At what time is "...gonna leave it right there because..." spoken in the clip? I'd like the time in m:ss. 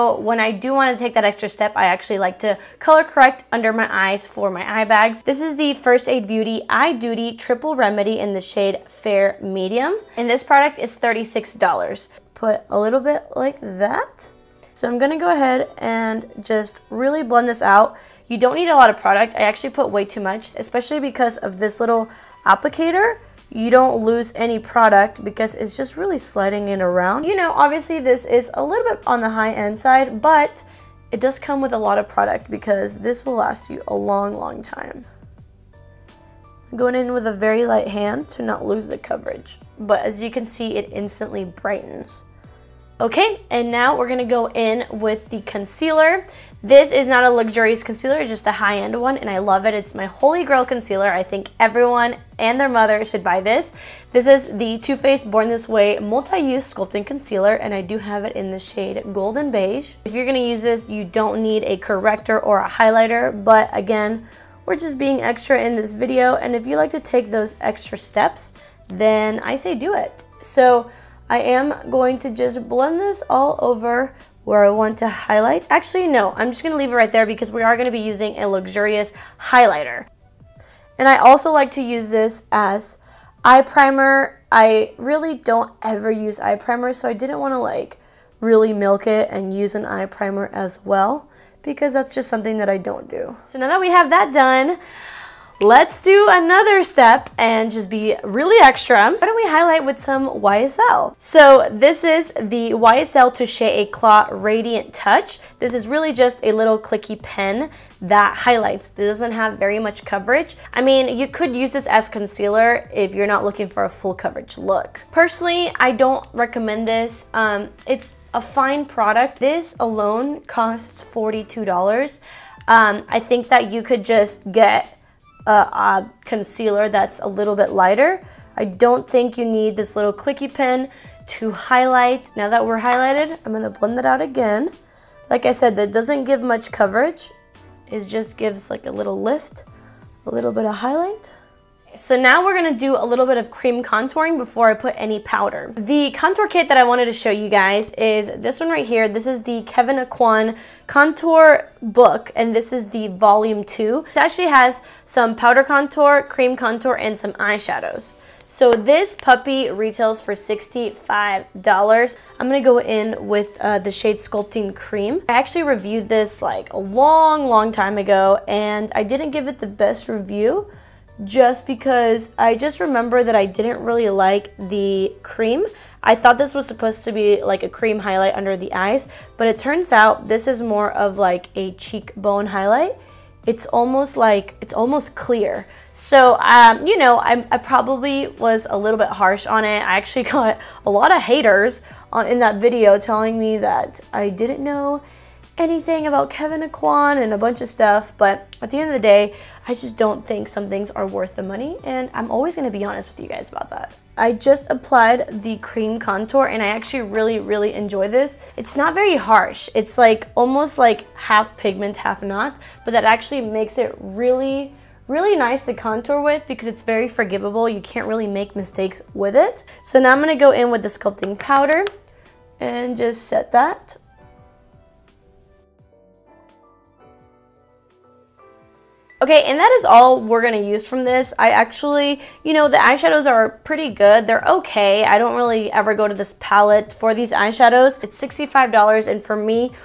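1:16.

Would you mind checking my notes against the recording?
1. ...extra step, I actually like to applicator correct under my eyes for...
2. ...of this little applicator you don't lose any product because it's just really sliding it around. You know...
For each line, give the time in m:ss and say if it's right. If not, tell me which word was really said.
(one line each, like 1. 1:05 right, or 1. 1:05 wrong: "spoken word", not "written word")
1. 0:01 wrong: "color", not "applicator"
2. 0:21 right.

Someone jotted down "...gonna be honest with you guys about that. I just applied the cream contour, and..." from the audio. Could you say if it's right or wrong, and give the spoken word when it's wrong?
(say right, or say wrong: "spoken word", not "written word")
right.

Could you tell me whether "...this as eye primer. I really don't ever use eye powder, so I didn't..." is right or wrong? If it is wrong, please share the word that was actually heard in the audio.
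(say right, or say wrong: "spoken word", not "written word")
wrong: "primer", not "powder".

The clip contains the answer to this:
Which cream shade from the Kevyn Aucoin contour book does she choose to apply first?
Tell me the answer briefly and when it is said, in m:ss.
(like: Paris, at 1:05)
Sculpting Cream, at 2:44.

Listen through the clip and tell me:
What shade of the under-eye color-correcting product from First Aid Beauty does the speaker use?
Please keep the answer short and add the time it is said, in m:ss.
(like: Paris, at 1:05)
Fair Medium, at 0:08.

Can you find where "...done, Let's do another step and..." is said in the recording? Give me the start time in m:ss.
1:34.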